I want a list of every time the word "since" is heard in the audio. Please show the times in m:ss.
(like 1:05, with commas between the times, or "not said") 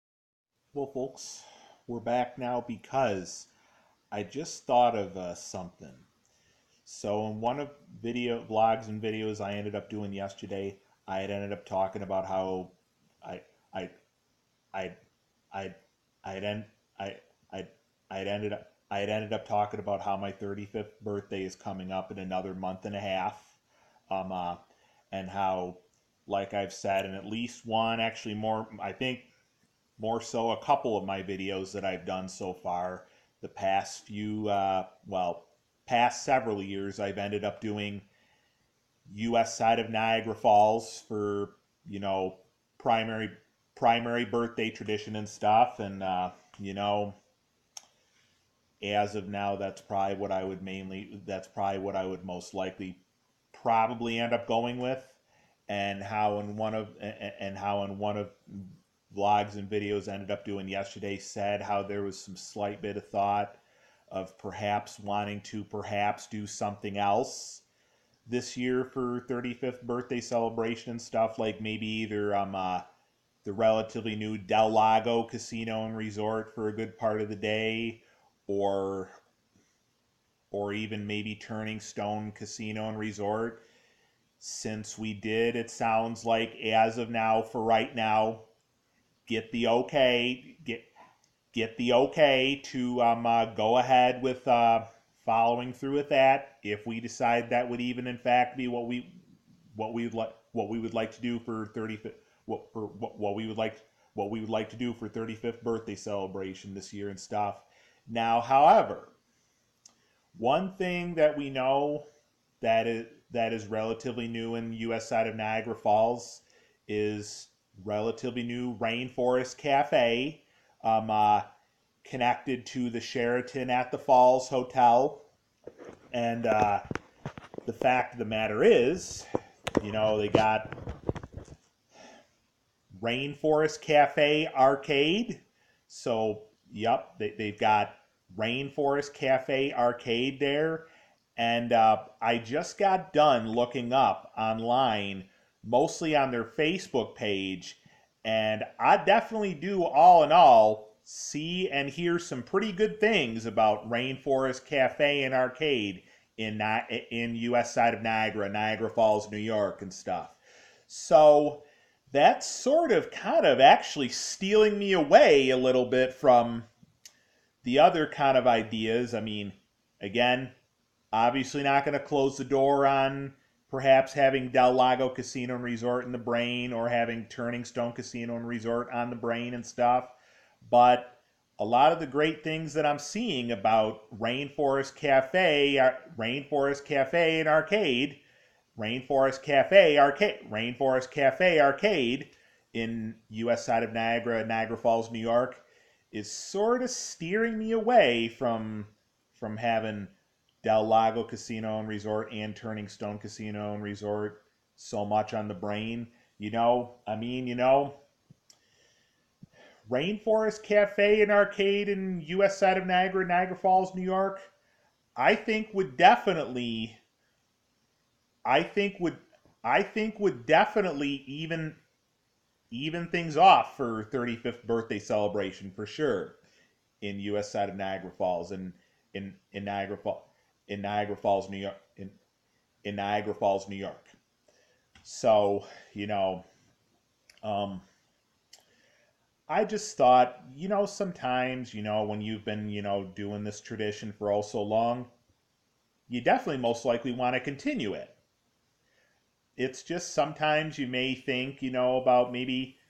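1:24.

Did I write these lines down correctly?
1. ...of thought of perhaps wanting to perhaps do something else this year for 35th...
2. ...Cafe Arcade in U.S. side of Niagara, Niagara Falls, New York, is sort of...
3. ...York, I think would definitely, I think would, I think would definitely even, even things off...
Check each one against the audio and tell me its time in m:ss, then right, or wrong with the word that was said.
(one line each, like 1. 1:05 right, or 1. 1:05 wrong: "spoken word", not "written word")
1. 1:02 right
2. 3:11 right
3. 3:34 right.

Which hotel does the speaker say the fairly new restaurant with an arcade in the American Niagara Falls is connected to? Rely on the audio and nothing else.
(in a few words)
Sheraton at the Falls.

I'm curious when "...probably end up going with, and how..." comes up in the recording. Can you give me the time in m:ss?
0:53.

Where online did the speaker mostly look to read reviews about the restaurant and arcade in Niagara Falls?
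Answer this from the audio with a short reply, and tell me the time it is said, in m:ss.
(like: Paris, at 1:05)
Facebook page, at 2:26.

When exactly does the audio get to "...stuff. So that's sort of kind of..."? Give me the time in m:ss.
2:39.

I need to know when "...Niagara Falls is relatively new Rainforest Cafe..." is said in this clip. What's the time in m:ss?
1:55.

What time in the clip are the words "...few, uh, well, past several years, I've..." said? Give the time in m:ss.
0:34.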